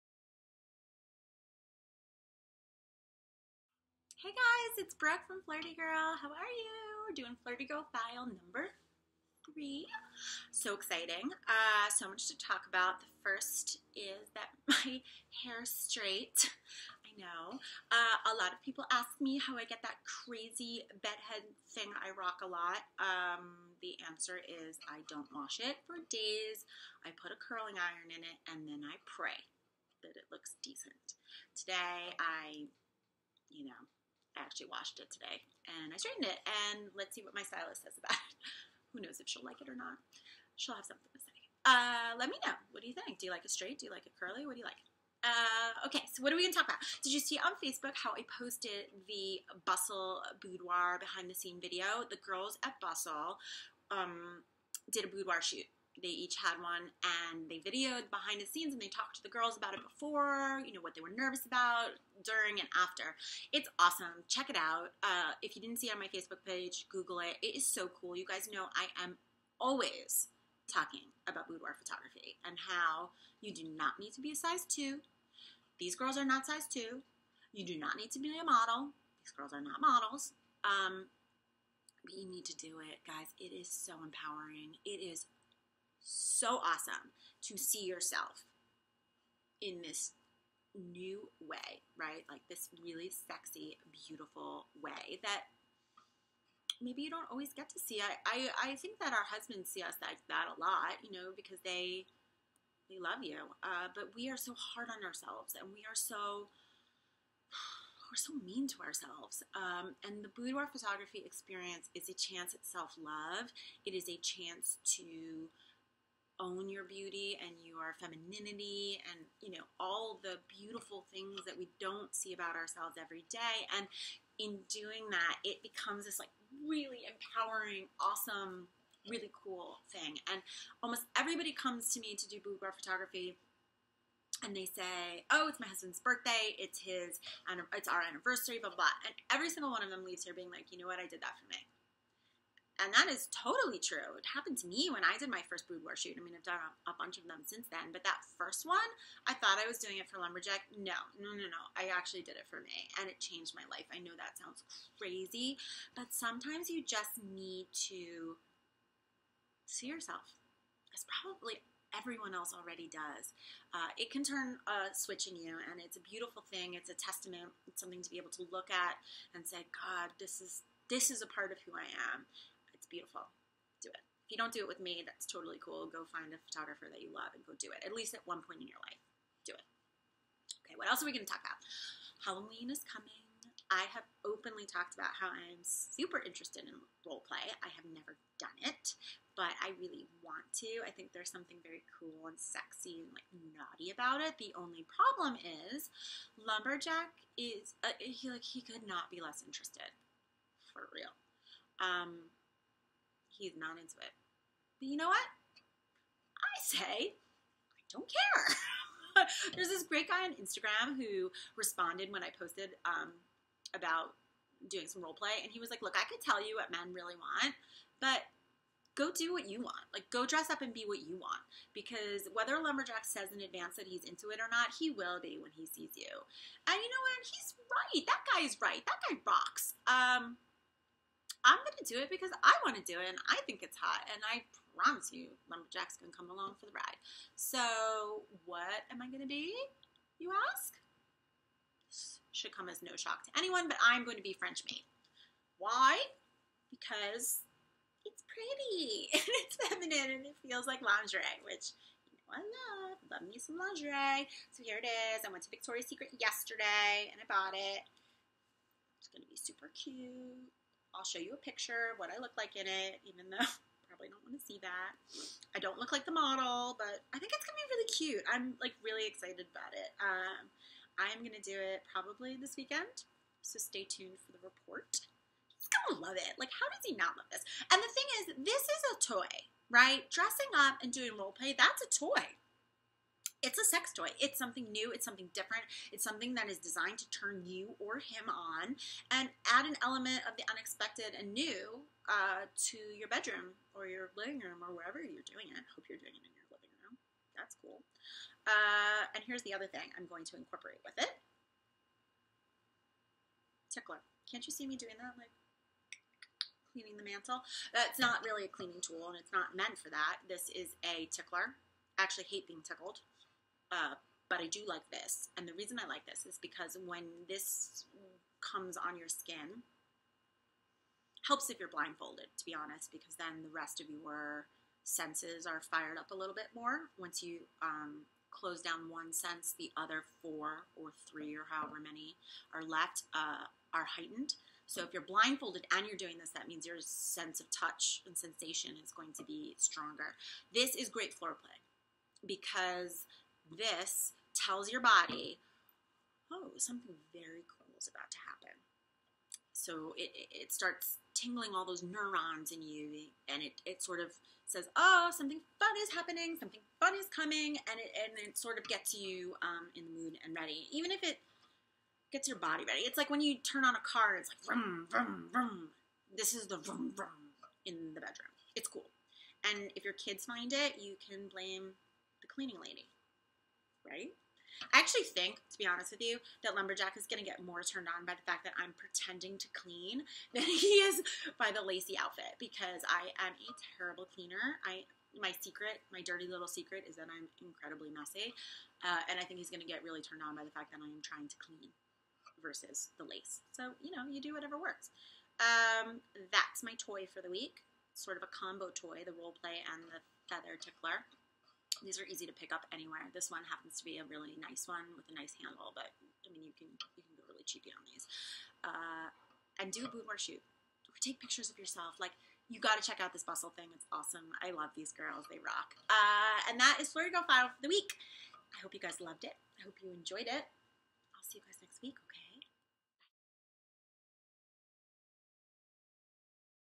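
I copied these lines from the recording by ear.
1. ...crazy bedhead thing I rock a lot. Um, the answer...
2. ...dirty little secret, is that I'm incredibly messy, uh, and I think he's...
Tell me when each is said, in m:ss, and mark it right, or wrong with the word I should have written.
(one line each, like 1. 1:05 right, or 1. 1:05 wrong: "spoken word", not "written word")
1. 0:20 right
2. 6:25 right.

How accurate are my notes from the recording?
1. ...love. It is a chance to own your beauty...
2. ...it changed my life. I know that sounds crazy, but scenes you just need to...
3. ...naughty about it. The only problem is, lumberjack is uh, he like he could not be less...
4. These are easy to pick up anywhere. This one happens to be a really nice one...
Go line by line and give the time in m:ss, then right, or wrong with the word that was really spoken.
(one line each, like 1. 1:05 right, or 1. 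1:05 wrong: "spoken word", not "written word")
1. 1:52 right
2. 2:33 wrong: "sometimes", not "scenes"
3. 3:13 right
4. 6:41 right.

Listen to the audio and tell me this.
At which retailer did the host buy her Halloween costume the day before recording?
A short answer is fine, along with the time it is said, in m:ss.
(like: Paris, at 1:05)
Victoria's Secret, at 4:15.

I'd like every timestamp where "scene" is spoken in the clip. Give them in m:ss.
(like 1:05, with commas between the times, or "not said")
0:51, 0:58.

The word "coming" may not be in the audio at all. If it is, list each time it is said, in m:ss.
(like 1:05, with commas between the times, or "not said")
3:02, 5:57.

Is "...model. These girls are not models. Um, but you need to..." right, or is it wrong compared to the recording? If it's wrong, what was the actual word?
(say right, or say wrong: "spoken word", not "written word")
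right.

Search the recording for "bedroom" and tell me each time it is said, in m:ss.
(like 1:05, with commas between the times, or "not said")
4:53, 6:08.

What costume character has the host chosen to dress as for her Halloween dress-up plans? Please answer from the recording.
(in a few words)
French maid.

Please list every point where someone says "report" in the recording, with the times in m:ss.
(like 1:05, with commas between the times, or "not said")
4:34.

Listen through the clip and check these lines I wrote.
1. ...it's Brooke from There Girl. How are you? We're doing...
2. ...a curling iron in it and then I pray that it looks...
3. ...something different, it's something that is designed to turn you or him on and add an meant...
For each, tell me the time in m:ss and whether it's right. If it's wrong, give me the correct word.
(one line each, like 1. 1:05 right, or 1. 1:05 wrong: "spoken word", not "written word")
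1. 0:04 wrong: "Flirty", not "There"
2. 0:27 right
3. 4:45 wrong: "element", not "meant".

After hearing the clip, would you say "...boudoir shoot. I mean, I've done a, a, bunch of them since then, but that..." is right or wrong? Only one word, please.
right.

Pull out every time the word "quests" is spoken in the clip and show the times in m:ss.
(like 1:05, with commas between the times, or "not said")
not said.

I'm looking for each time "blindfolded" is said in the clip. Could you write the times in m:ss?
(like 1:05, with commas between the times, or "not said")
5:21, 5:35.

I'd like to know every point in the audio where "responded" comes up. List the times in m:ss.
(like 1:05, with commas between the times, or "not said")
3:31.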